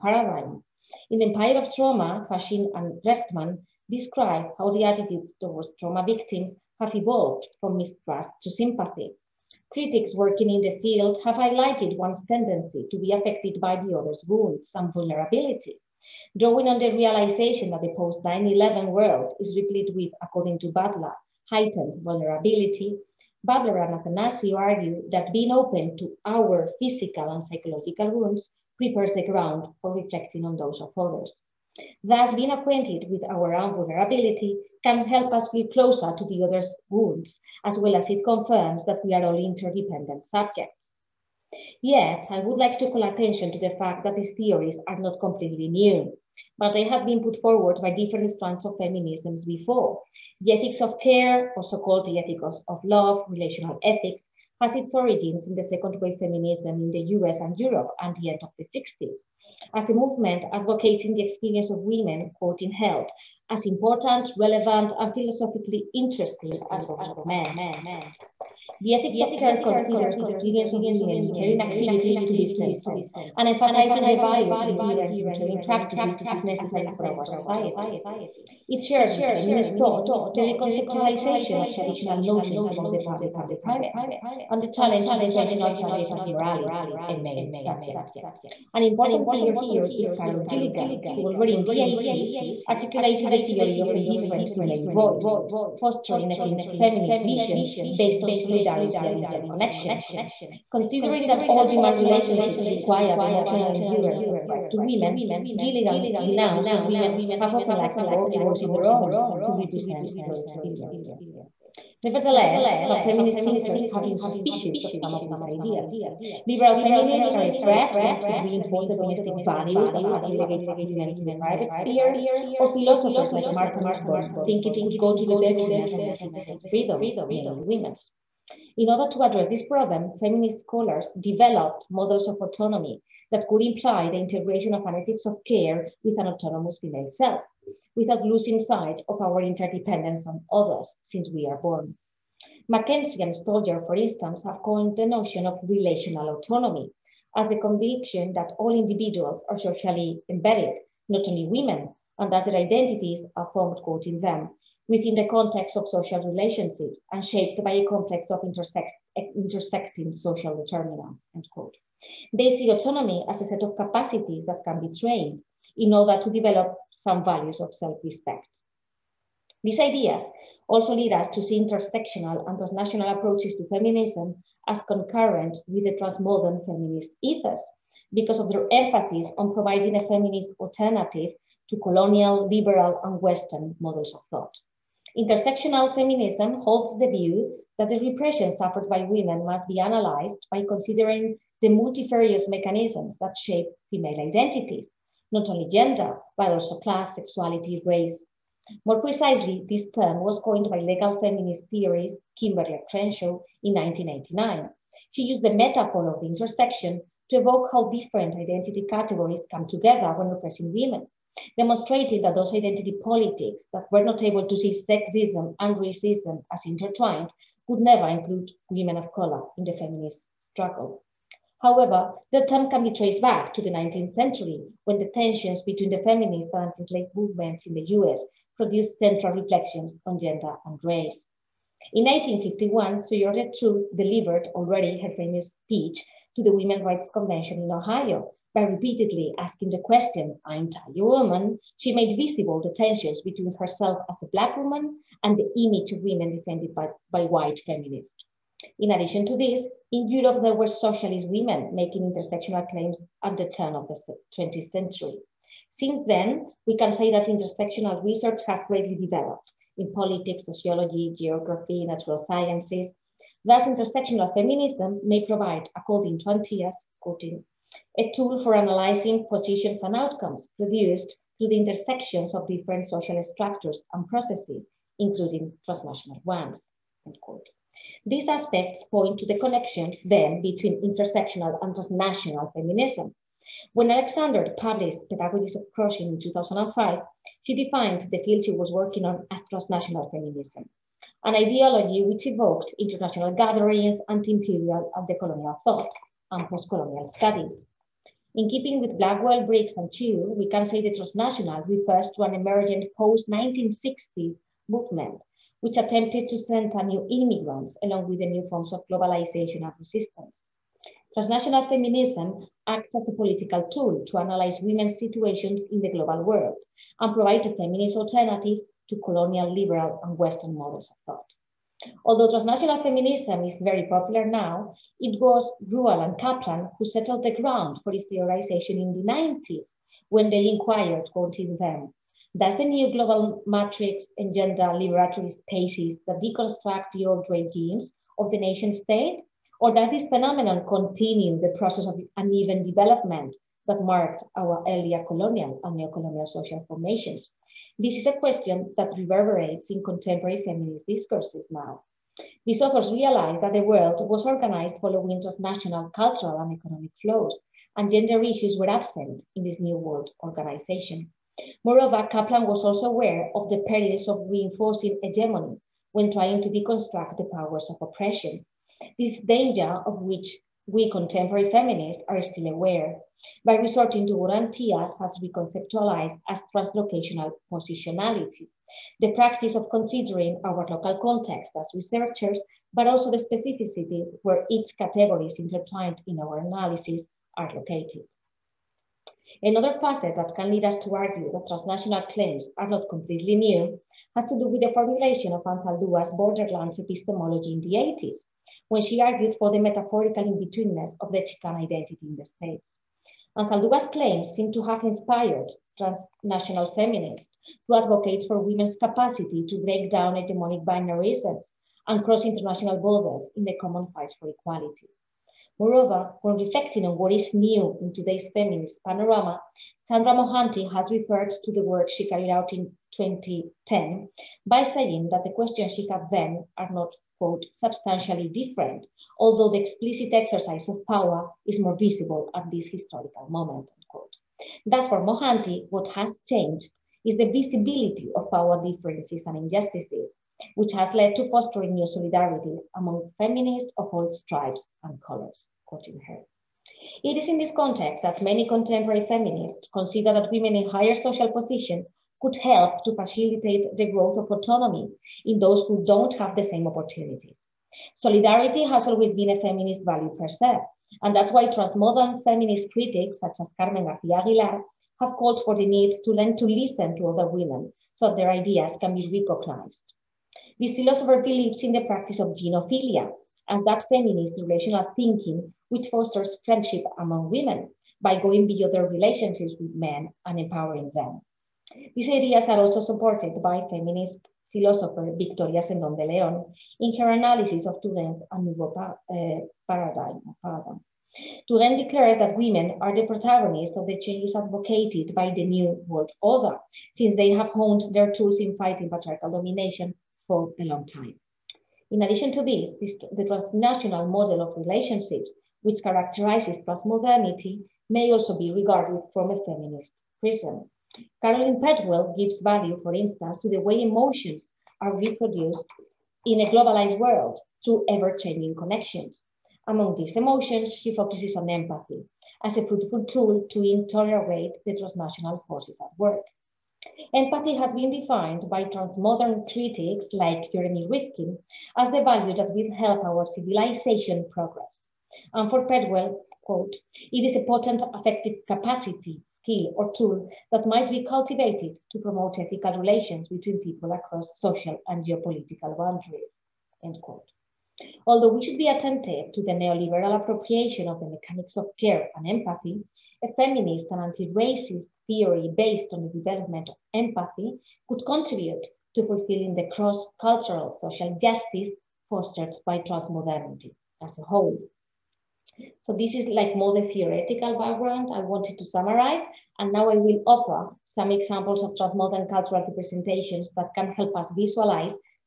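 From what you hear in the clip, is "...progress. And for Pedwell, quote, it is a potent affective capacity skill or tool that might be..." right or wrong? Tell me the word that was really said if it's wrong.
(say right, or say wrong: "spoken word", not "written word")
right.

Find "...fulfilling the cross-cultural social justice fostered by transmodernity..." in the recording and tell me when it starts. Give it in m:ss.
9:19.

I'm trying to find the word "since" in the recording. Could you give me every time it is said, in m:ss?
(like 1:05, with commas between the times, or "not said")
2:21, 4:15, 8:16.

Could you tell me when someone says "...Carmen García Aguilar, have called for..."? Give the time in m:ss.
7:43.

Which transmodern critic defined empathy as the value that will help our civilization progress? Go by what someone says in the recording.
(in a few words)
Jeremy Rifkin.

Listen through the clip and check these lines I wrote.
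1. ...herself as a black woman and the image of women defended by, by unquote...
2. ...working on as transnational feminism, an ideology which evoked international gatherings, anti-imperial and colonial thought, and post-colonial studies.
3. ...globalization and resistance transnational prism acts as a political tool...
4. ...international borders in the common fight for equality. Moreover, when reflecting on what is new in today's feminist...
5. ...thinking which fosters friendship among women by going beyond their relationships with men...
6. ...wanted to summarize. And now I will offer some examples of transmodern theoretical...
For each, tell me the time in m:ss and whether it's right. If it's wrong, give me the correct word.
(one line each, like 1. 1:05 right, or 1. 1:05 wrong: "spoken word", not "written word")
1. 4:03 wrong: "white", not "unquote"
2. 4:48 right
3. 5:08 wrong: "feminism", not "prism"
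4. 6:52 right
5. 7:54 right
6. 9:28 wrong: "cultural", not "theoretical".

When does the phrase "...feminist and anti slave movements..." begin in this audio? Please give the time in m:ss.
3:46.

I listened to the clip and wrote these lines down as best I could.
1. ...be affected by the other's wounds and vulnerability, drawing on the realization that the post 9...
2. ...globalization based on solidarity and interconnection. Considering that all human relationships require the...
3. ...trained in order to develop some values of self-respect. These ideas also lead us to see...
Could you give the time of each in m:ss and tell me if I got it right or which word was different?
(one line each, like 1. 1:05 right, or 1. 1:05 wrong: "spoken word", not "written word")
1. 0:12 right
2. 1:37 wrong: "vision", not "globalization"
3. 2:44 right.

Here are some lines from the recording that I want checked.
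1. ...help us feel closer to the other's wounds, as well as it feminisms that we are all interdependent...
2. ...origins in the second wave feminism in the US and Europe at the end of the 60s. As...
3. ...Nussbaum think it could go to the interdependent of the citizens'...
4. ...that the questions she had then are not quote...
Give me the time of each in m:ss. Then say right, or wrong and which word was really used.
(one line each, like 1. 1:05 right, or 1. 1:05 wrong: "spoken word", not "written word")
1. 0:35 wrong: "confirms", not "feminisms"
2. 0:54 right
3. 2:03 wrong: "detriment", not "interdependent"
4. 7:05 right.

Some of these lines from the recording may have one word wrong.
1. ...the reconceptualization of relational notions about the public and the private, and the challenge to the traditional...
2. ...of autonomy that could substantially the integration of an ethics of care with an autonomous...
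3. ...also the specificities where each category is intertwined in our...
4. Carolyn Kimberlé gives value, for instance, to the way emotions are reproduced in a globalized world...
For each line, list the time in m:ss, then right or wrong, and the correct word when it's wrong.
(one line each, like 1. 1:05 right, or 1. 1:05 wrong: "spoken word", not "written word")
1. 1:20 wrong: "traditional", not "relational"
2. 2:12 wrong: "imply", not "substantially"
3. 6:22 right
4. 8:31 wrong: "Pedwell", not "Kimberlé".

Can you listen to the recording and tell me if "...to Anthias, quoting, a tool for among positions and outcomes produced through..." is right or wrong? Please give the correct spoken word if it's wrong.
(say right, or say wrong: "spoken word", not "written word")
wrong: "analyzing", not "among".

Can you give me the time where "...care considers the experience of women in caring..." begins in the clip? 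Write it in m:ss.
1:09.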